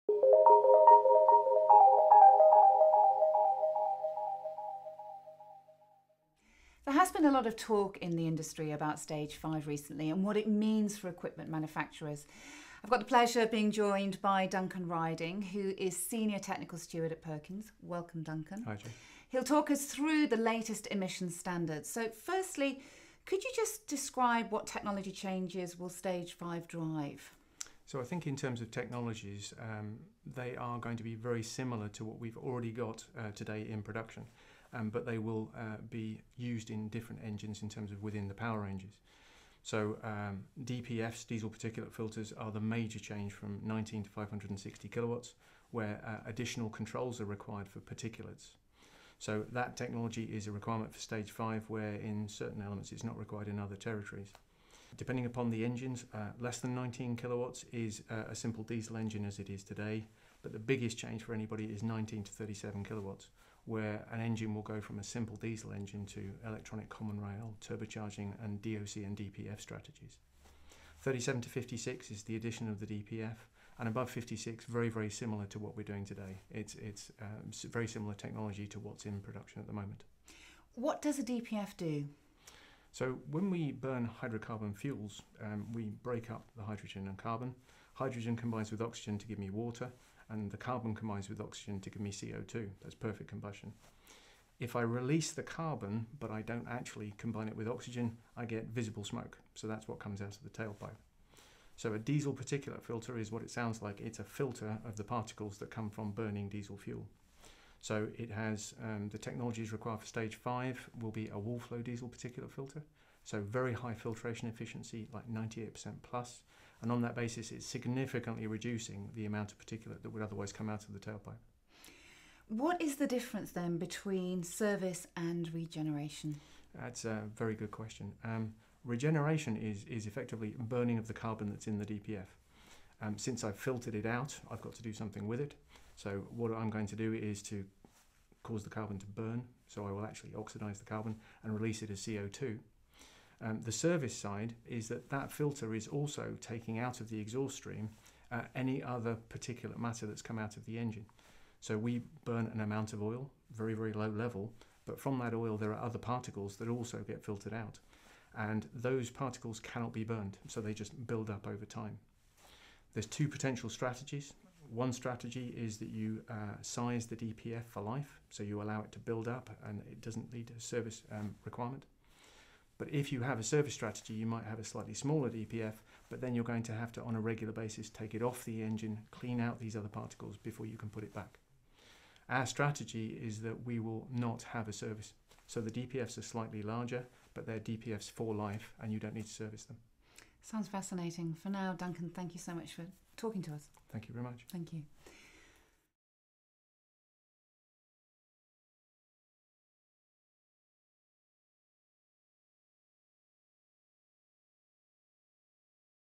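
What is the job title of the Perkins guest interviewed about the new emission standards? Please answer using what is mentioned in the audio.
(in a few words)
Senior Technical Steward.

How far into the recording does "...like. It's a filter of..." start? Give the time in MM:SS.
01:43.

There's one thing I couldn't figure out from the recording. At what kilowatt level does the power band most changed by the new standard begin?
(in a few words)
19.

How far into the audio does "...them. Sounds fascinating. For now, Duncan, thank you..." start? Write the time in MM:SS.
03:09.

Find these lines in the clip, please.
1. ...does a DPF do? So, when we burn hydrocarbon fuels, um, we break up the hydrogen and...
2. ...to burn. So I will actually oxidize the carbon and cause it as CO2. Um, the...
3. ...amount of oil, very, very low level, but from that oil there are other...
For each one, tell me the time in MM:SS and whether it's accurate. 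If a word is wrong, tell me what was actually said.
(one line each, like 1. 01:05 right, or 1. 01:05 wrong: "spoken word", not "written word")
1. 01:21 right
2. 02:18 wrong: "release", not "cause"
3. 02:32 right.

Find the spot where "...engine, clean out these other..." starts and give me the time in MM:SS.
02:58.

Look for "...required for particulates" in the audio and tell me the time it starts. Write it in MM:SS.
00:47.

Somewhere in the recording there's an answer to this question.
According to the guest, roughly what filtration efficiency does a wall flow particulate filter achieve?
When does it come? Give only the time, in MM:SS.
01:55.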